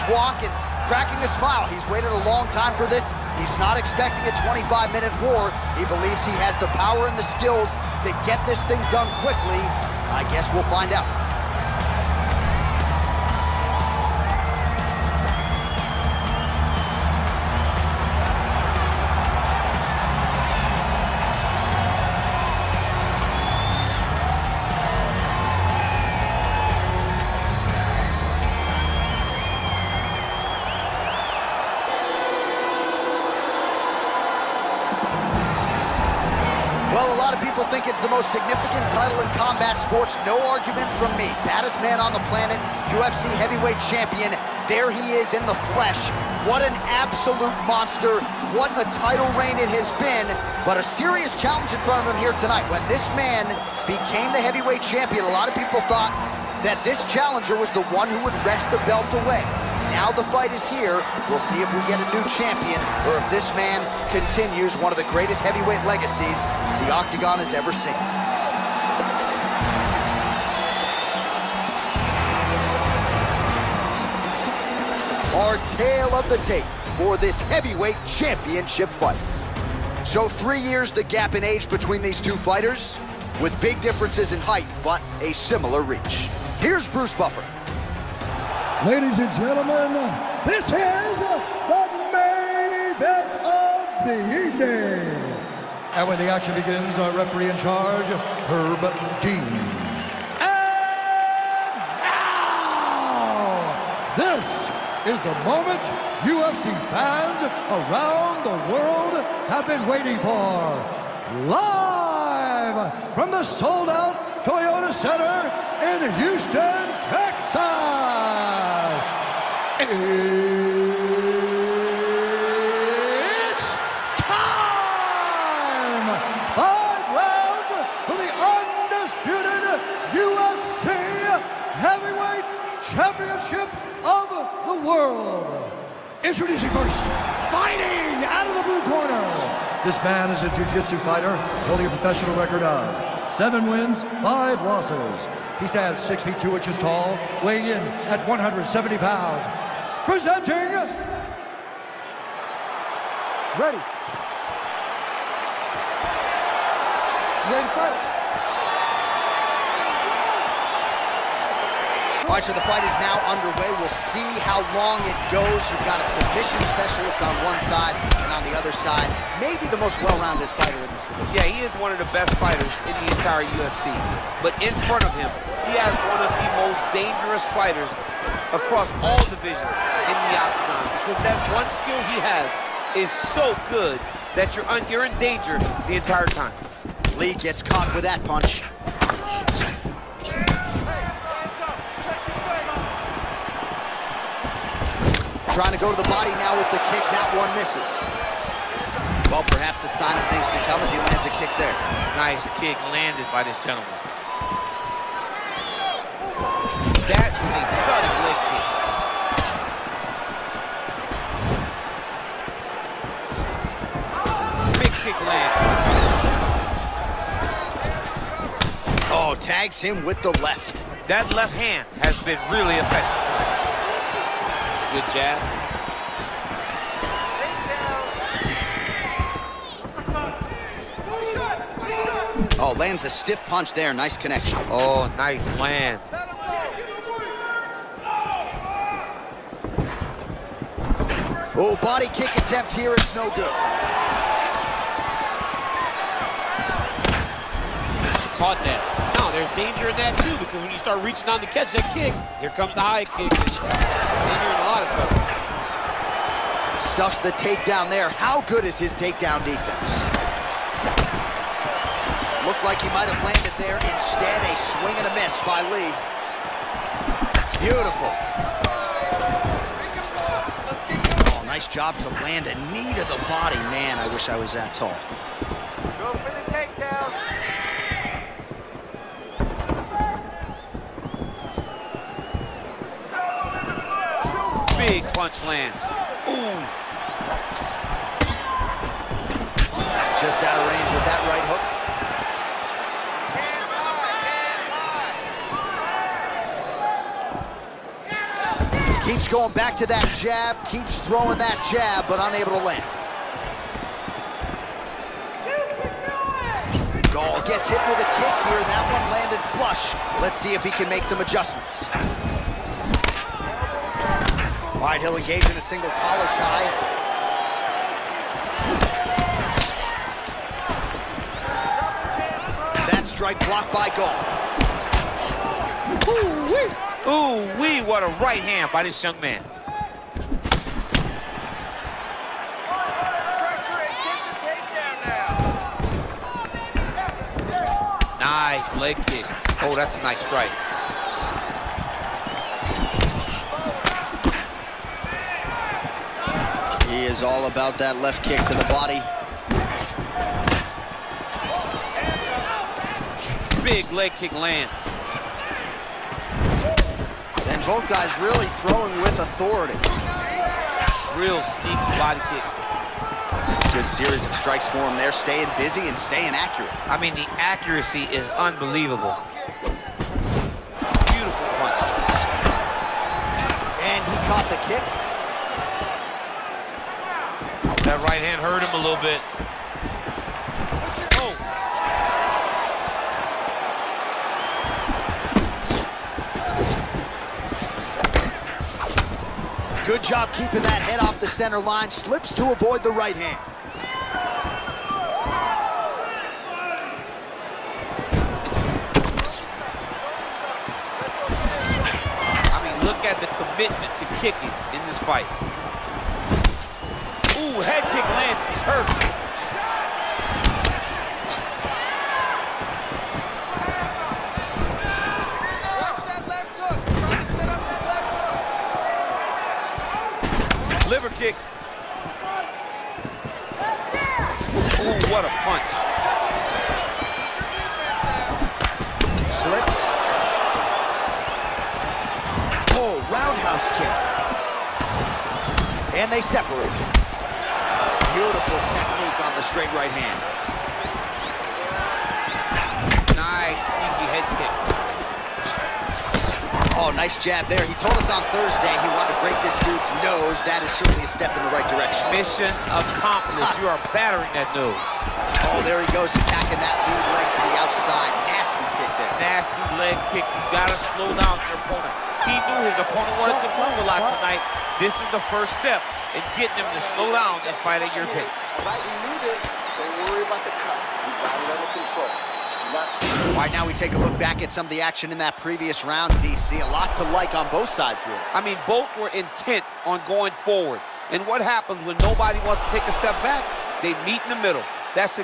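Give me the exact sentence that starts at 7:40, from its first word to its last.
You gotta slow down your opponent.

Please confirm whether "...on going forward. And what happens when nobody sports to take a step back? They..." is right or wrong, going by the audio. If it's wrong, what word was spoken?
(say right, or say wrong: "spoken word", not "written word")
wrong: "wants", not "sports".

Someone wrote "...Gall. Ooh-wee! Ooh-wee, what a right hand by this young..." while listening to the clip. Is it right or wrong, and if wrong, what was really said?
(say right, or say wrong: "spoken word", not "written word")
right.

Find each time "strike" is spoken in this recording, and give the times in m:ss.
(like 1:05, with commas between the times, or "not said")
5:23, 5:40, 6:04.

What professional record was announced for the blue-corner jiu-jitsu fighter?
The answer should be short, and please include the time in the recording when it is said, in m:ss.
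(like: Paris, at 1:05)
7 wins, 5 losses, at 2:23.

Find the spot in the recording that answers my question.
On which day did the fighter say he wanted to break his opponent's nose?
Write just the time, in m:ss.
7:28.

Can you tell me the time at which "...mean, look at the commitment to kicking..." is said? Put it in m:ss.
6:42.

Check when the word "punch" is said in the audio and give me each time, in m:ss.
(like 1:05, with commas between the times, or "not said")
3:08, 3:53, 4:45, 6:11, 7:05.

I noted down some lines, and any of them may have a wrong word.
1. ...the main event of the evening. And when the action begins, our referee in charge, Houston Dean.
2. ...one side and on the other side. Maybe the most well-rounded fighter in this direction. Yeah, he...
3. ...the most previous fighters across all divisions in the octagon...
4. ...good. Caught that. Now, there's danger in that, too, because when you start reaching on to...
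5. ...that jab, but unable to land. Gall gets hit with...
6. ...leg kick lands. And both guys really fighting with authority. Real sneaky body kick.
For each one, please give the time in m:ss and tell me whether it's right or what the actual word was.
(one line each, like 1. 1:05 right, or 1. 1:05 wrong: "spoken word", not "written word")
1. 1:31 wrong: "Herb", not "Houston"
2. 2:47 wrong: "division", not "direction"
3. 2:56 wrong: "dangerous", not "previous"
4. 4:03 right
5. 5:01 right
6. 5:53 wrong: "throwing", not "fighting".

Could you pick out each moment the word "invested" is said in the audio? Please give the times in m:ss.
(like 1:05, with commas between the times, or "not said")
not said.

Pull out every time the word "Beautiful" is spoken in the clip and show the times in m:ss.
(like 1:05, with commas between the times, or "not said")
4:27, 6:11, 7:18.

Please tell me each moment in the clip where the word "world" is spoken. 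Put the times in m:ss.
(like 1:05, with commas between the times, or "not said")
1:48, 2:14.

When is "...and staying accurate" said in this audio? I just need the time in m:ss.
6:05.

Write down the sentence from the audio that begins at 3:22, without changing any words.
Nice kick landed by this gentleman.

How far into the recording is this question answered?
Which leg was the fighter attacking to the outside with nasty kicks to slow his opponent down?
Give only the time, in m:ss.
7:36.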